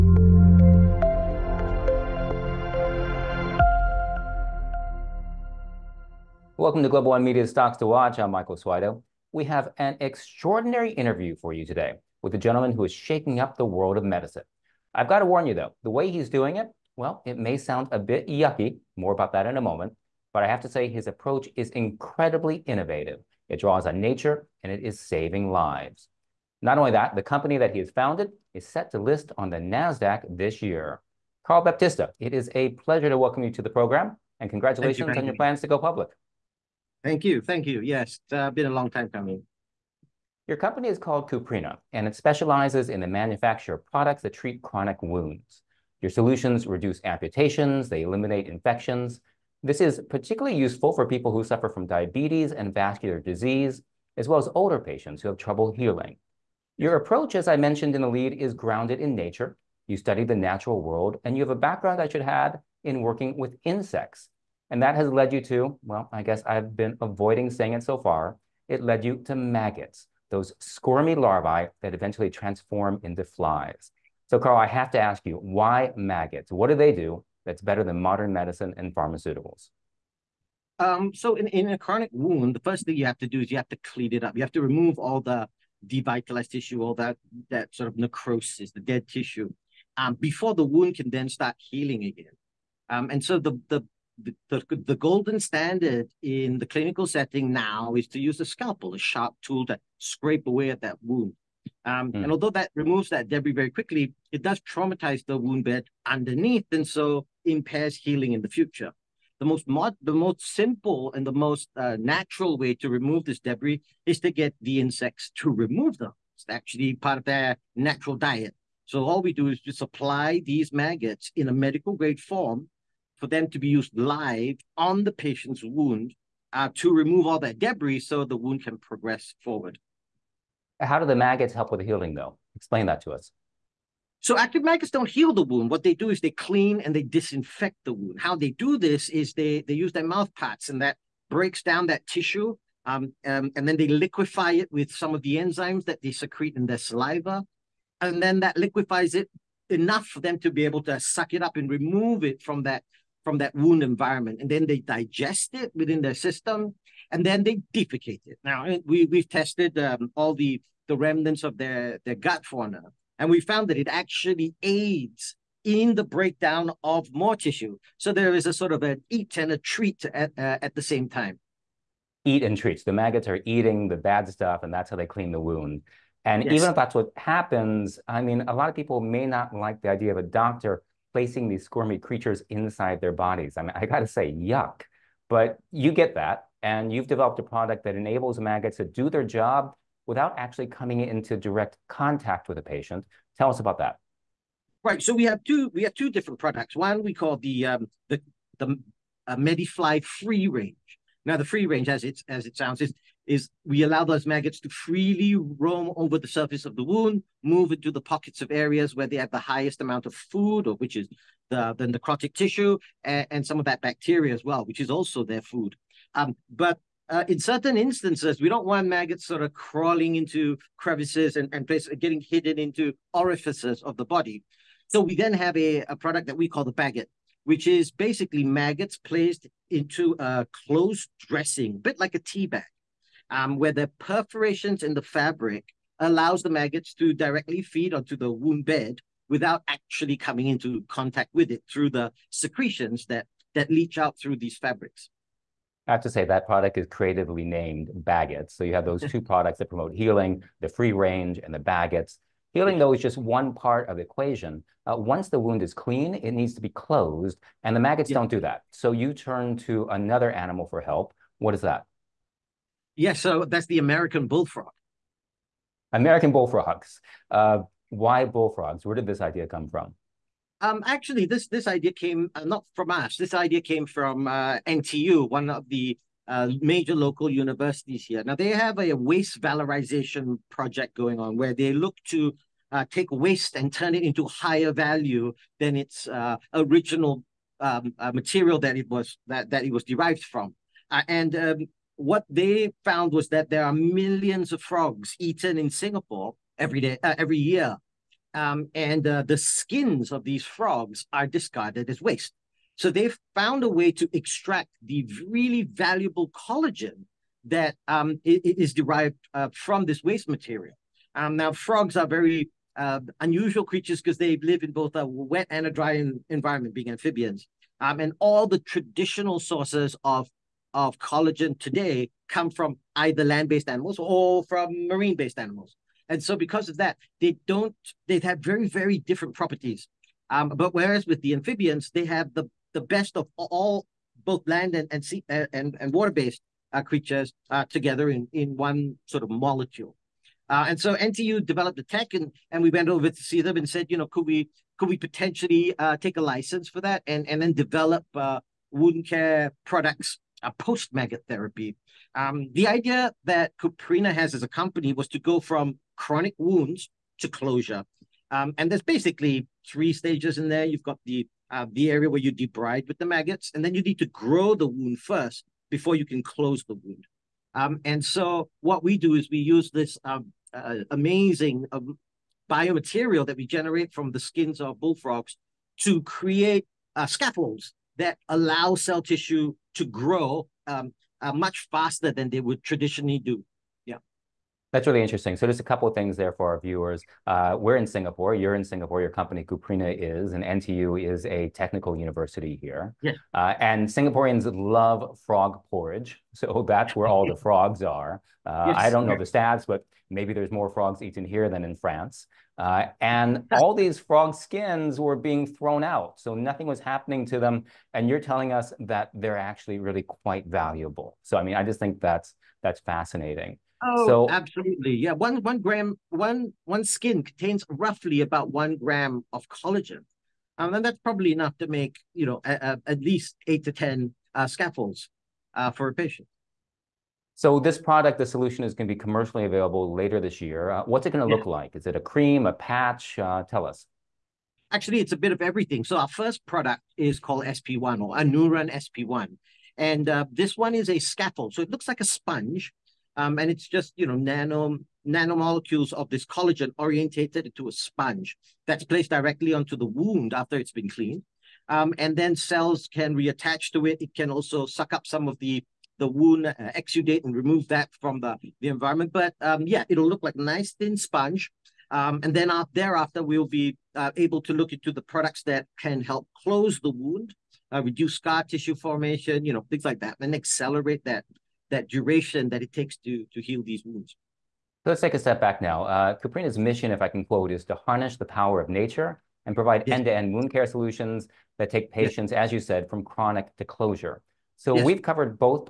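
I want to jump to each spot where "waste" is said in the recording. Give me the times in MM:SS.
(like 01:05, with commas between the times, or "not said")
04:38, 04:43, 05:02, 05:10.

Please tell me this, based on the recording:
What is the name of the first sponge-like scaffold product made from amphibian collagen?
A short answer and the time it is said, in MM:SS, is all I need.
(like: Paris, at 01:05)
Anuran SP1, at 07:18.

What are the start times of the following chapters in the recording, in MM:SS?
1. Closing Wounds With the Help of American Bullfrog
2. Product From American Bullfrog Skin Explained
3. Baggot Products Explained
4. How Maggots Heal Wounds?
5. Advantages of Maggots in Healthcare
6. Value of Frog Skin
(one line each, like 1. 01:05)
1. 04:12
2. 07:06
3. 02:56
4. 02:10
5. 00:39
6. 06:42.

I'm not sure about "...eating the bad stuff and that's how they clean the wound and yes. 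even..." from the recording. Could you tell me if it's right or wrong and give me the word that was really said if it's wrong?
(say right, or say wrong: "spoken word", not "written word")
right.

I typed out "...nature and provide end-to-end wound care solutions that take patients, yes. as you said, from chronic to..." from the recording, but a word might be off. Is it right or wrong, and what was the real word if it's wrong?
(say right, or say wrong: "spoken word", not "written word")
right.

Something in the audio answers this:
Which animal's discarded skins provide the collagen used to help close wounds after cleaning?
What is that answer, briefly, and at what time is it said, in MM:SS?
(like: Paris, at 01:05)
American bullfrog, at 04:23.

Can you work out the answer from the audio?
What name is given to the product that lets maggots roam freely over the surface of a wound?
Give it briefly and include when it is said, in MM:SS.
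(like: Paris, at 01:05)
MediFly free range, at 03:19.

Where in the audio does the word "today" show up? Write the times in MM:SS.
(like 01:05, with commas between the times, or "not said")
00:11, 05:21.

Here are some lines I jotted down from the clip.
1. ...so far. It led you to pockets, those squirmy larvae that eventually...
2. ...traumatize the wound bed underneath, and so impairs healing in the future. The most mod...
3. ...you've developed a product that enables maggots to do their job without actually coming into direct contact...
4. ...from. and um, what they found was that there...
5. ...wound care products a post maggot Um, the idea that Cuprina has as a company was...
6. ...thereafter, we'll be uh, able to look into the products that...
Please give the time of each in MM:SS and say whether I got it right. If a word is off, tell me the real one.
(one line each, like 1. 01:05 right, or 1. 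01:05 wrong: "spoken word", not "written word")
1. 01:07 wrong: "maggots", not "pockets"
2. 01:44 right
3. 03:06 right
4. 04:50 right
5. 05:48 right
6. 07:42 right.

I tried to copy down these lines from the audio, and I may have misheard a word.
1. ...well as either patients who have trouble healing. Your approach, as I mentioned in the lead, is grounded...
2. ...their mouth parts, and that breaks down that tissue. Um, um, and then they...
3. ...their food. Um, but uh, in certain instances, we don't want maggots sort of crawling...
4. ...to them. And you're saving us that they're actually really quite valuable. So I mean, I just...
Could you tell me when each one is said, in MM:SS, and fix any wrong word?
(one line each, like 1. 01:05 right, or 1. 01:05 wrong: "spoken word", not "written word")
1. 00:54 wrong: "older", not "either"
2. 02:19 right
3. 03:35 right
4. 06:47 wrong: "telling", not "saving".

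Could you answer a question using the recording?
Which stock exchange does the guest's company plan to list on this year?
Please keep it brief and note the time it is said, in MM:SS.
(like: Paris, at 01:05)
NASDAQ, at 00:29.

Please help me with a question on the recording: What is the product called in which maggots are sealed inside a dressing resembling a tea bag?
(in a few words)
Baggot.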